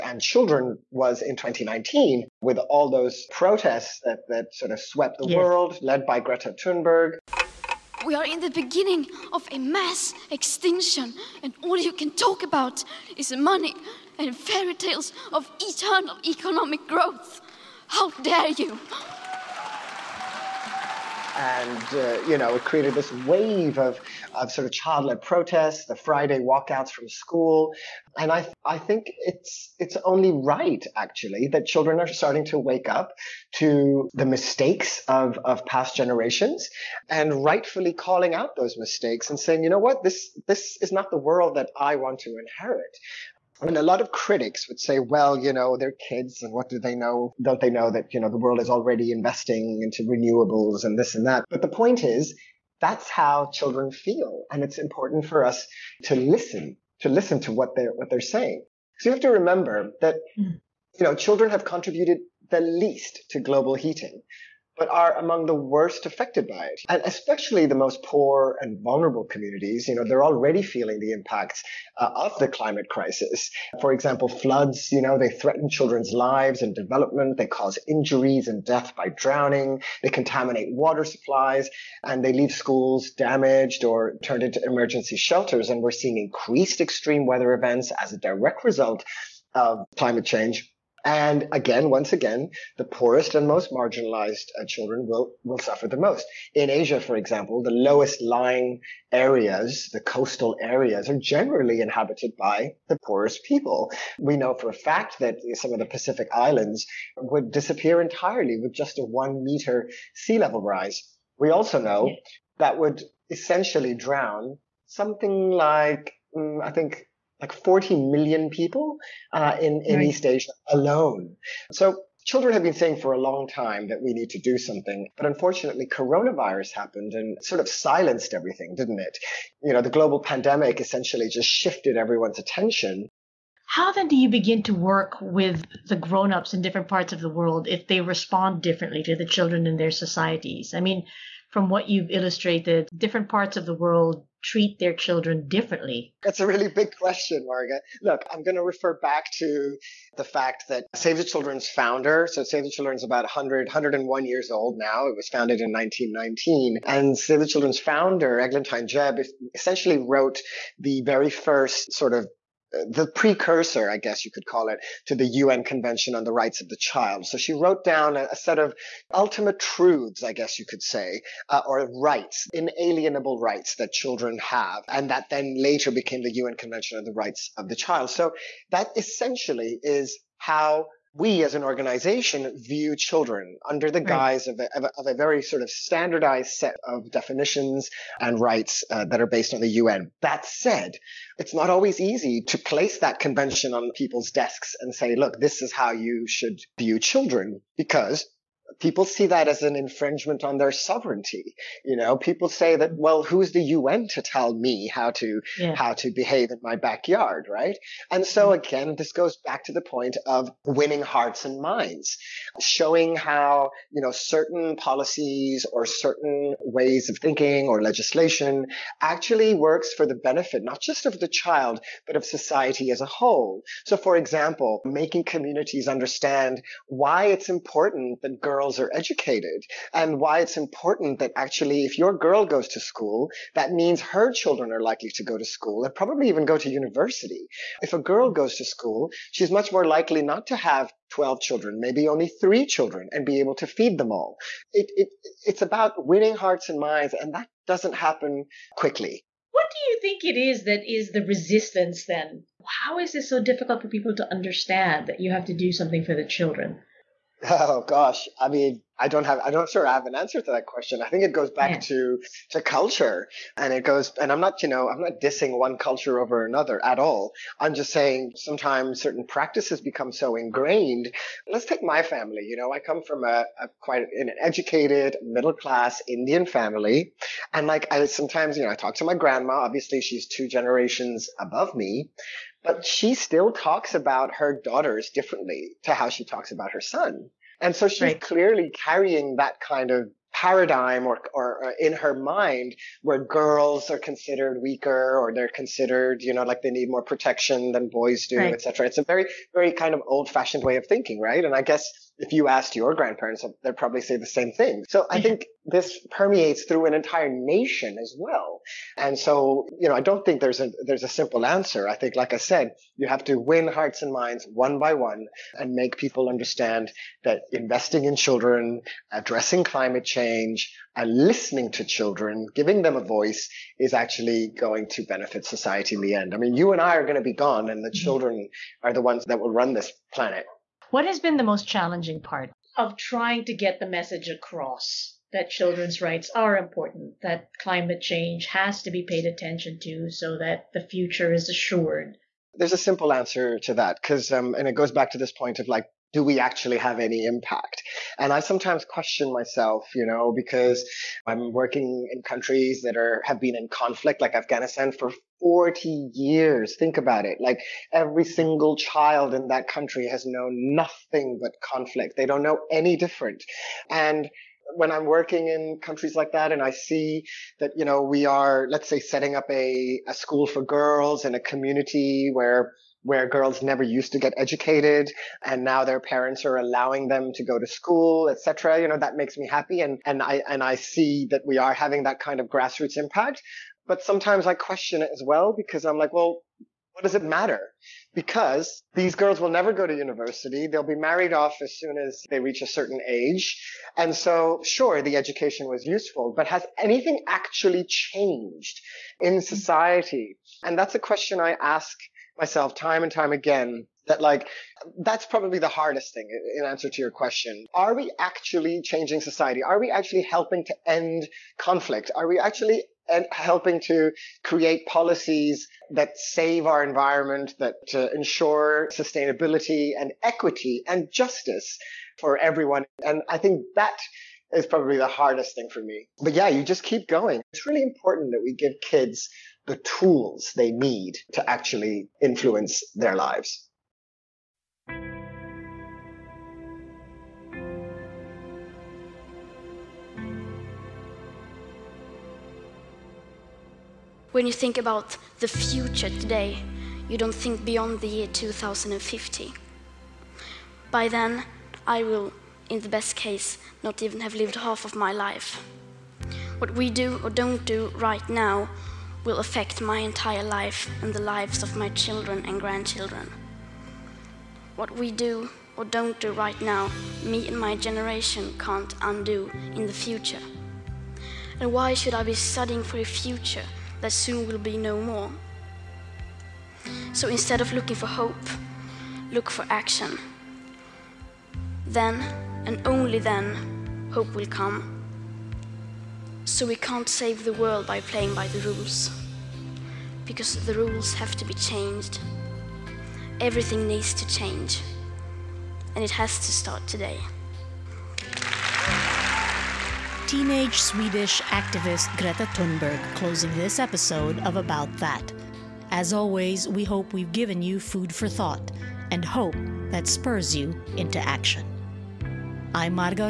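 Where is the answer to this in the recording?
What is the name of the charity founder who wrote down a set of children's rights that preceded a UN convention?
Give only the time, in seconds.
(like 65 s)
158 s.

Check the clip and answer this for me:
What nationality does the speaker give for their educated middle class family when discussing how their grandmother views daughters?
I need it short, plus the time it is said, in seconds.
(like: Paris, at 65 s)
Indian, at 276 s.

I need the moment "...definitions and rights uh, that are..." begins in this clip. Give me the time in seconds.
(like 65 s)
187 s.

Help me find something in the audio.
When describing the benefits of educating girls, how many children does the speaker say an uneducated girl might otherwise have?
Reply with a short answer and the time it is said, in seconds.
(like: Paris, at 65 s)
12, at 241 s.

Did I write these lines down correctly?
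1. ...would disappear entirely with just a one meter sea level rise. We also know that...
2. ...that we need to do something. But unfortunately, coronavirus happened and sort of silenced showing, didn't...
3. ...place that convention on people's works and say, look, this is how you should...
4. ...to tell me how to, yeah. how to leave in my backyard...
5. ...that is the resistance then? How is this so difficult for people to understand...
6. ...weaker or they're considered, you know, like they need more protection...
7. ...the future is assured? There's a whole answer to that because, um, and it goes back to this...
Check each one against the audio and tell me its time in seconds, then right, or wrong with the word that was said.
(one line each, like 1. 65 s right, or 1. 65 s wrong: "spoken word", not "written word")
1. 107 s right
2. 123 s wrong: "everything", not "showing"
3. 192 s wrong: "desks", not "works"
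4. 204 s wrong: "behave", not "leave"
5. 250 s right
6. 294 s right
7. 340 s wrong: "simple", not "whole".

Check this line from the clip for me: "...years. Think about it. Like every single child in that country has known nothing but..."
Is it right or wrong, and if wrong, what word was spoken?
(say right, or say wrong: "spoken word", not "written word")
right.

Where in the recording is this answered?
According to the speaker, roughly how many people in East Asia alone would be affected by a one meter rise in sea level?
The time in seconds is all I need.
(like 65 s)
117 s.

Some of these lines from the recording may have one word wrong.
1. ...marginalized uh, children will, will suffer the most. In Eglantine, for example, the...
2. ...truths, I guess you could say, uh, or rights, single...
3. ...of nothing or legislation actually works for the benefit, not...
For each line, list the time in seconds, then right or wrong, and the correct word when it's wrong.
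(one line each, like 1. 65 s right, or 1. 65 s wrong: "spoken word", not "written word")
1. 93 s wrong: "Asia", not "Eglantine"
2. 169 s wrong: "inalienable", not "single"
3. 217 s wrong: "thinking", not "nothing".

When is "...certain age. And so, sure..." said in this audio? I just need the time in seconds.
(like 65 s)
392 s.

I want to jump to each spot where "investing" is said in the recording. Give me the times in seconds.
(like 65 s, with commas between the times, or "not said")
49 s, 317 s.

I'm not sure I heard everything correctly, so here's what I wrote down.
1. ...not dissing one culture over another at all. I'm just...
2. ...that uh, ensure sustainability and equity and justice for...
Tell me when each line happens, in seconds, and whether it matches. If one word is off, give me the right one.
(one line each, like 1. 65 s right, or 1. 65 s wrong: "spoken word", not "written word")
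1. 265 s right
2. 417 s right.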